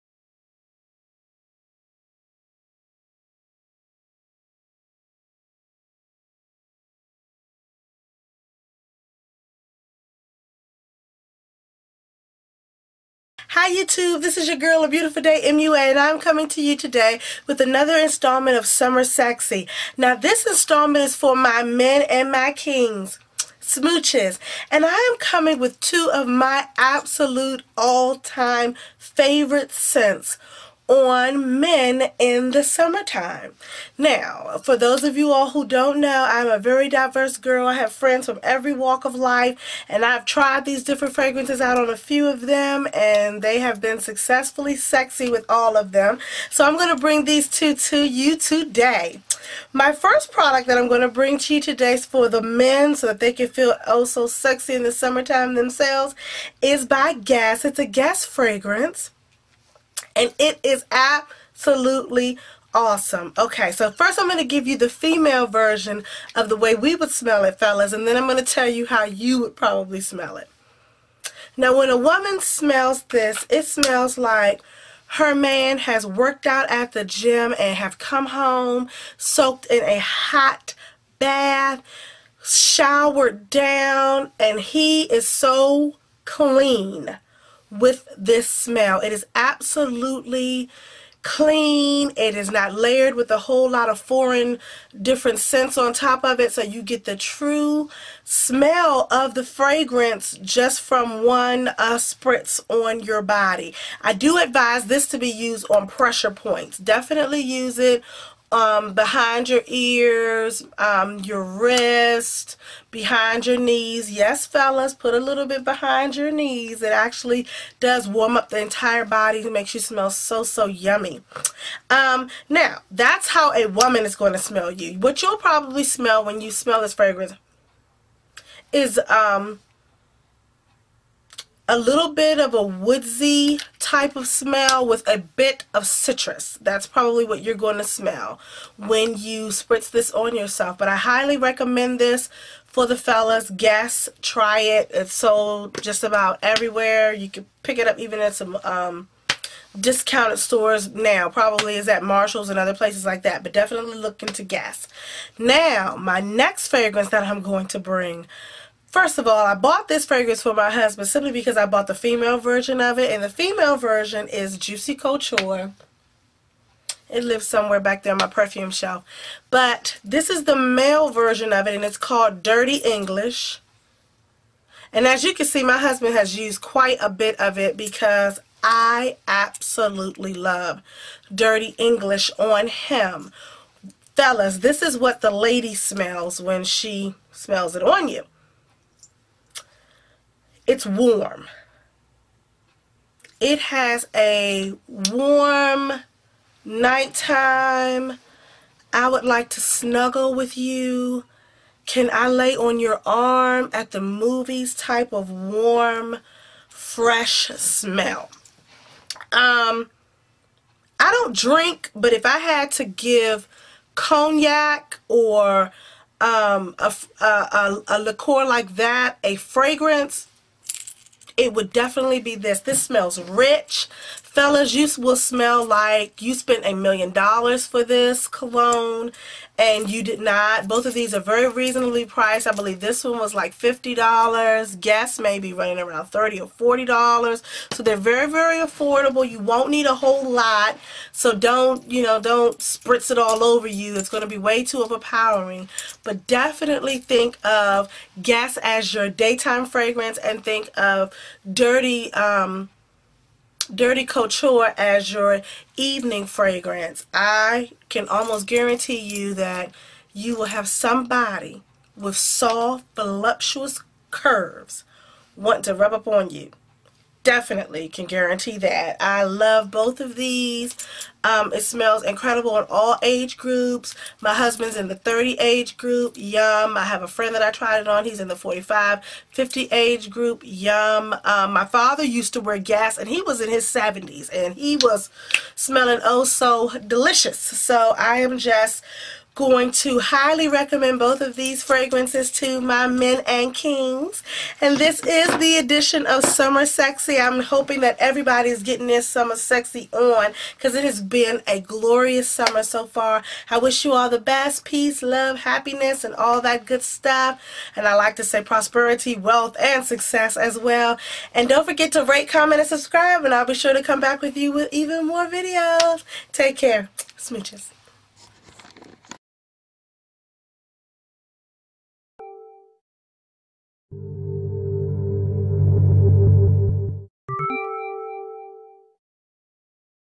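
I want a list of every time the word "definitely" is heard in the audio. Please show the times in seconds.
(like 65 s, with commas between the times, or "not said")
106 s, 153 s, 221 s, 246 s, 267 s.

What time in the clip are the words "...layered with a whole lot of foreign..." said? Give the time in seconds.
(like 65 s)
92 s.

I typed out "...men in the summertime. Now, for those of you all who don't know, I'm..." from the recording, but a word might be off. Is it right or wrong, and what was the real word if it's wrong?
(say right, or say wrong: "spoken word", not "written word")
right.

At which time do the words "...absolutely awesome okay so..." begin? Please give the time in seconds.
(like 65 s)
60 s.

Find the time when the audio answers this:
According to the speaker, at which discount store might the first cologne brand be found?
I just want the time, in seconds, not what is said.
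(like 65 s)
152 s.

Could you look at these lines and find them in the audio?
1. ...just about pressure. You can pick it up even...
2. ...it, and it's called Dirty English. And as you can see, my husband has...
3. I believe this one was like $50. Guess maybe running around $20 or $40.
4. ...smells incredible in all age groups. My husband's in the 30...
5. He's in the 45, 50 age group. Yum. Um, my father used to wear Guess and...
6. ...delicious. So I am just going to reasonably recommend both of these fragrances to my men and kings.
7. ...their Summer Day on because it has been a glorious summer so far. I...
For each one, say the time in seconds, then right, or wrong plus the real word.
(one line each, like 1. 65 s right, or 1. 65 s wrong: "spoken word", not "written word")
1. 145 s wrong: "everywhere", not "pressure"
2. 171 s right
3. 232 s wrong: "30", not "20"
4. 271 s right
5. 278 s right
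6. 286 s wrong: "highly", not "reasonably"
7. 298 s wrong: "Sexy", not "Day".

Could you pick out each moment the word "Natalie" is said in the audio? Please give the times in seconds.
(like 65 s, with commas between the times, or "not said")
not said.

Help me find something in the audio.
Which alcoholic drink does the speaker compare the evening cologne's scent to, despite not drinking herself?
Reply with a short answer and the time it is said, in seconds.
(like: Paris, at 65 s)
Cognac, at 213 s.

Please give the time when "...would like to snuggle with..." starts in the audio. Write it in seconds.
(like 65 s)
199 s.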